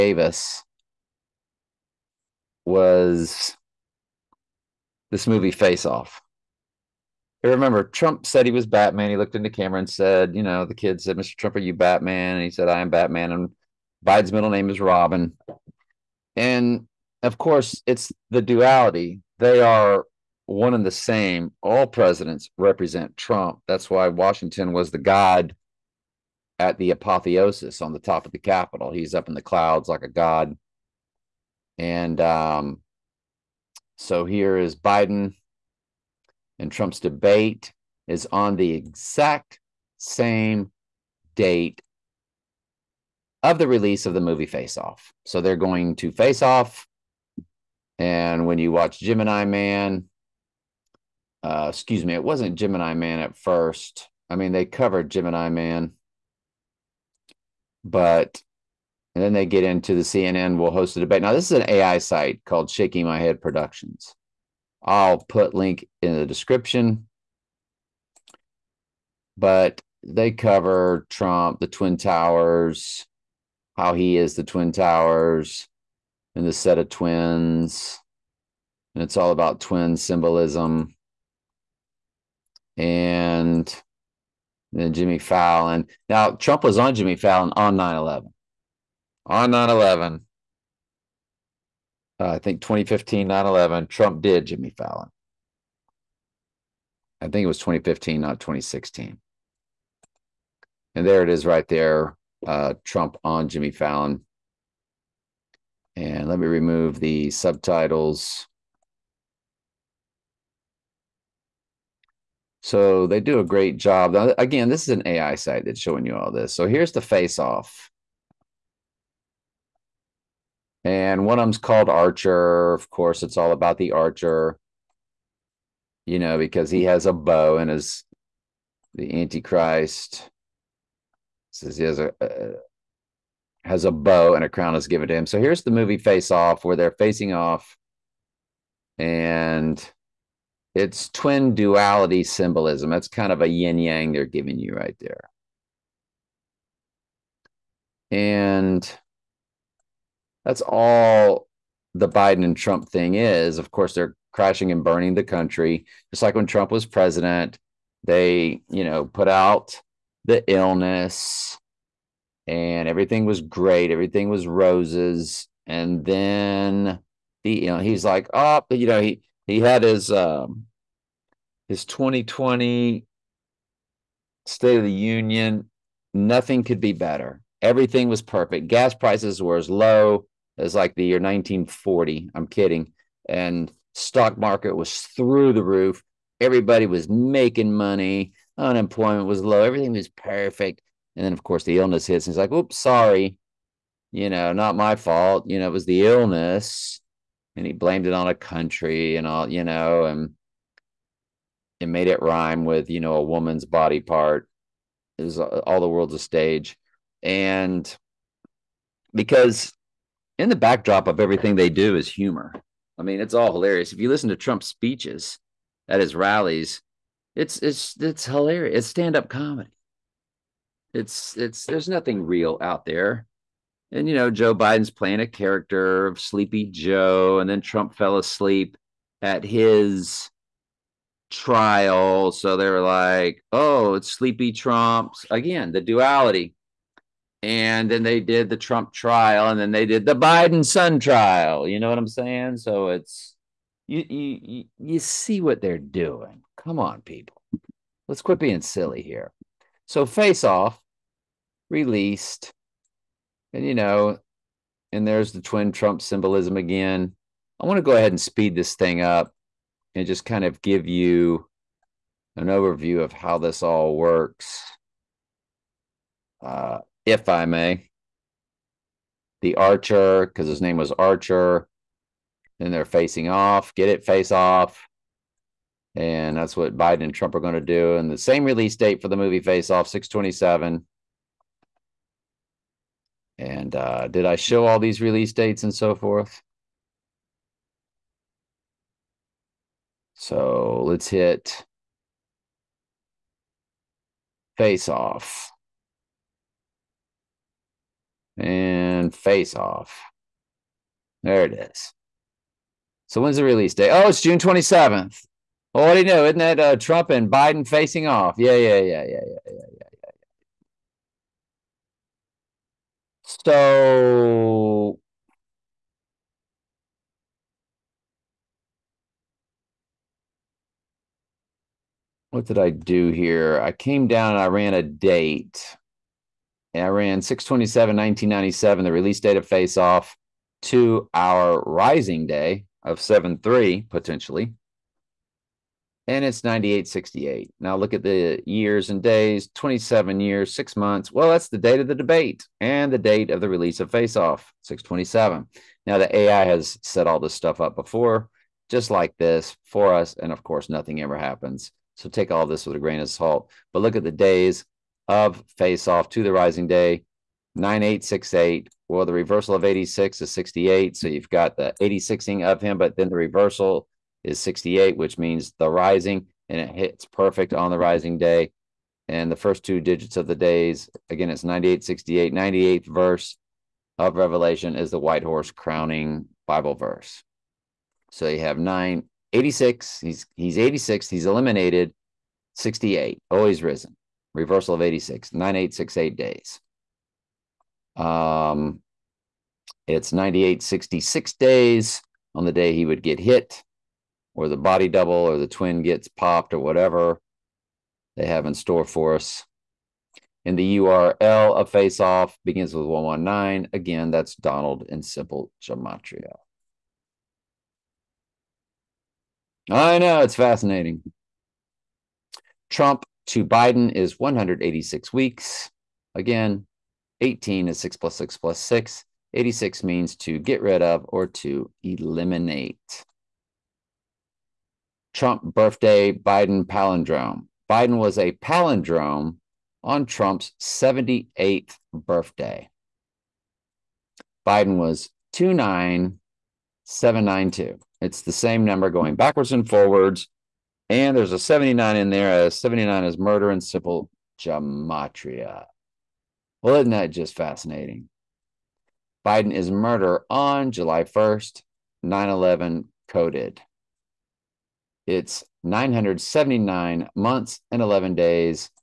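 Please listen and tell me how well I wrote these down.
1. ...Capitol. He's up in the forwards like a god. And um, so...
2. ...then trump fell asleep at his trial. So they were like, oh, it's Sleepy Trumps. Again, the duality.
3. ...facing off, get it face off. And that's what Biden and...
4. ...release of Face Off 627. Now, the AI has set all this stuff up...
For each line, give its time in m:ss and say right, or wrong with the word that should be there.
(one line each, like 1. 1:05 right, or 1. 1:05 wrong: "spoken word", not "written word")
1. 0:28 wrong: "clouds", not "forwards"
2. 3:47 right
3. 4:32 right
4. 5:43 right.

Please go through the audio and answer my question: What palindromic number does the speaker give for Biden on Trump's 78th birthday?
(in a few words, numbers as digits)
29792.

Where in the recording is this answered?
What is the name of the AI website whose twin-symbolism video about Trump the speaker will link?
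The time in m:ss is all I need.
1:02.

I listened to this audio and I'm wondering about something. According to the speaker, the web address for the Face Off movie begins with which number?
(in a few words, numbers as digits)
119.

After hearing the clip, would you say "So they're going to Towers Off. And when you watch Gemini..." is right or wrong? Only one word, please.
wrong.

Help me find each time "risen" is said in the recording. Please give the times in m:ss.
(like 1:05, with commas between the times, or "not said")
6:23.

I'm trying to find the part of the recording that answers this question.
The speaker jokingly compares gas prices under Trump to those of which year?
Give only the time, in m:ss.
3:01.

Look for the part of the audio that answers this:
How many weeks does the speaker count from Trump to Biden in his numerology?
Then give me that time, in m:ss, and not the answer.
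6:54.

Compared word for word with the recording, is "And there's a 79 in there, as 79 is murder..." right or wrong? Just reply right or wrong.
right.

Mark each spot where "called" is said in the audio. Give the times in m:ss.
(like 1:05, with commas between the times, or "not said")
1:02, 2:01.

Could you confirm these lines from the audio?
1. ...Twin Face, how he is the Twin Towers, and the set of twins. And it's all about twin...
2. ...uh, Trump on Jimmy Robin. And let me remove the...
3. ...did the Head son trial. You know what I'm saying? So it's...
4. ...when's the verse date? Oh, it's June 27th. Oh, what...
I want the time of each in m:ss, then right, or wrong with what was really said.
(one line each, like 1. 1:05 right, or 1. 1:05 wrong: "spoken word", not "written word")
1. 1:11 wrong: "Towers", not "Face"
2. 1:42 wrong: "Fallon", not "Robin"
3. 3:59 wrong: "Biden", not "Head"
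4. 5:03 wrong: "release", not "verse".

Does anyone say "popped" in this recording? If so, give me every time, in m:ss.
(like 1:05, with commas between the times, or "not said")
6:36.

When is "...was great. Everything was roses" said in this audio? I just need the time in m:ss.
2:43.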